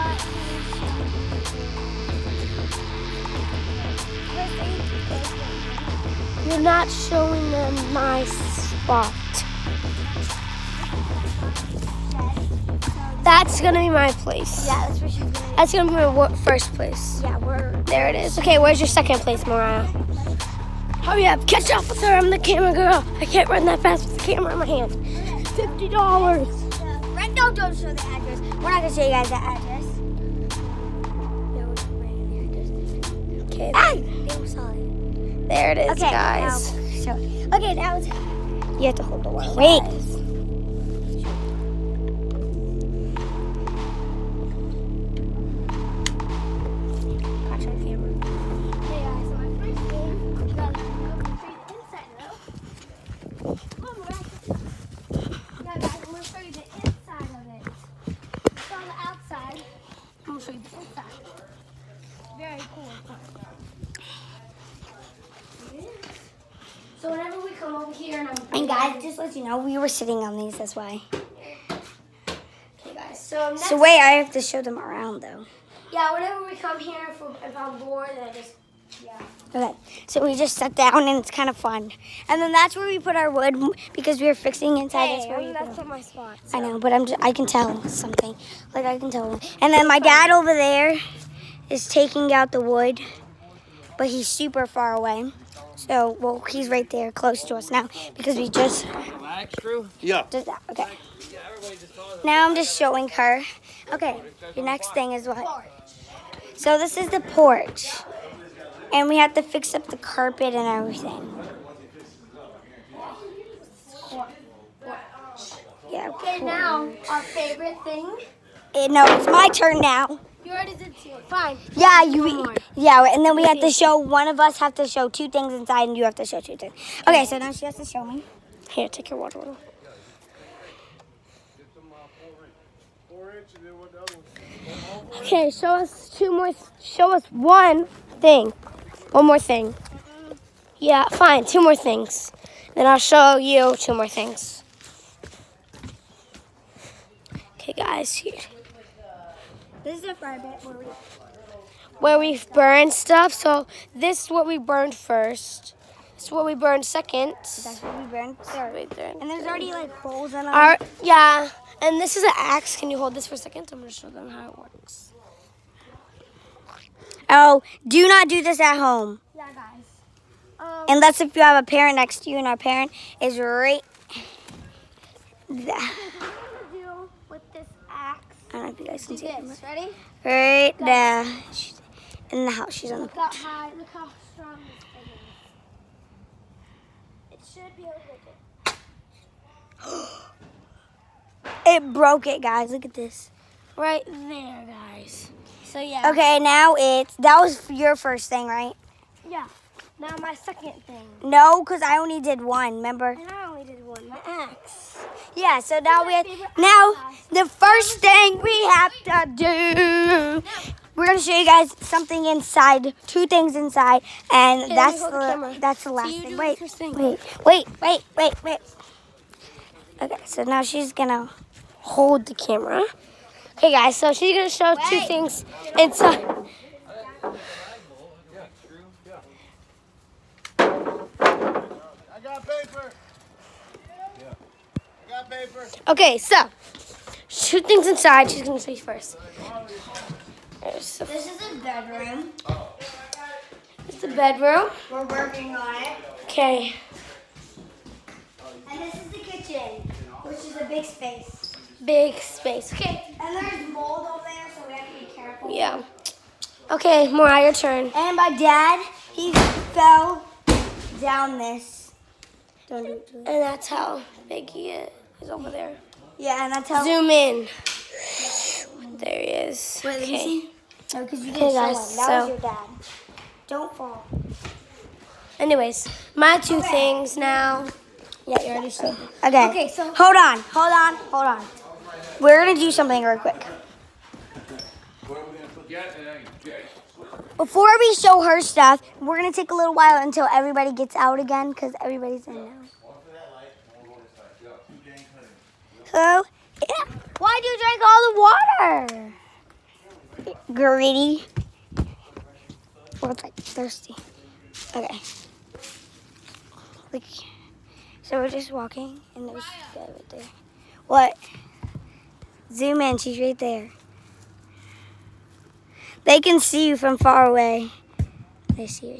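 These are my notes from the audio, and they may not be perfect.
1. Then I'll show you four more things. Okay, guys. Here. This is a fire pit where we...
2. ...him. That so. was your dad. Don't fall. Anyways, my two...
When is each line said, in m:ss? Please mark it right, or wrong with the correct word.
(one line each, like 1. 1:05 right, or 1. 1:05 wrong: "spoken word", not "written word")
1. 2:22 wrong: "two", not "four"
2. 4:32 right.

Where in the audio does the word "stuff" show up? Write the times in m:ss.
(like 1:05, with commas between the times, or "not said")
2:32, 4:48.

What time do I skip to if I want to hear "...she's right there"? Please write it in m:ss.
5:12.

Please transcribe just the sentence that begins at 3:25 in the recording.
Yeah, so now we have, now the first thing we have to do.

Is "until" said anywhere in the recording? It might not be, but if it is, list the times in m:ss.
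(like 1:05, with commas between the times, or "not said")
4:50.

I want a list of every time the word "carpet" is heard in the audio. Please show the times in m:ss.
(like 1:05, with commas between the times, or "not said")
1:49.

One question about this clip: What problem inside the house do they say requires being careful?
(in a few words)
Mold.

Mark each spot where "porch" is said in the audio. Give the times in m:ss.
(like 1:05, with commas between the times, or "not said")
1:47, 3:03.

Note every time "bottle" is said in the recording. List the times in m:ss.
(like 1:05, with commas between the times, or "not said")
2:09.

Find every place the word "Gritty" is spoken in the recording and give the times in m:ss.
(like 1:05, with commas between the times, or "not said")
5:00.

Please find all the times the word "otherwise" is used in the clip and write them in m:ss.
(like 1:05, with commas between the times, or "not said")
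not said.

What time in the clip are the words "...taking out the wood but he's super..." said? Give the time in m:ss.
1:31.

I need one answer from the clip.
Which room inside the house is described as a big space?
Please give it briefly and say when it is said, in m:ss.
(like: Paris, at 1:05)
The kitchen, at 4:09.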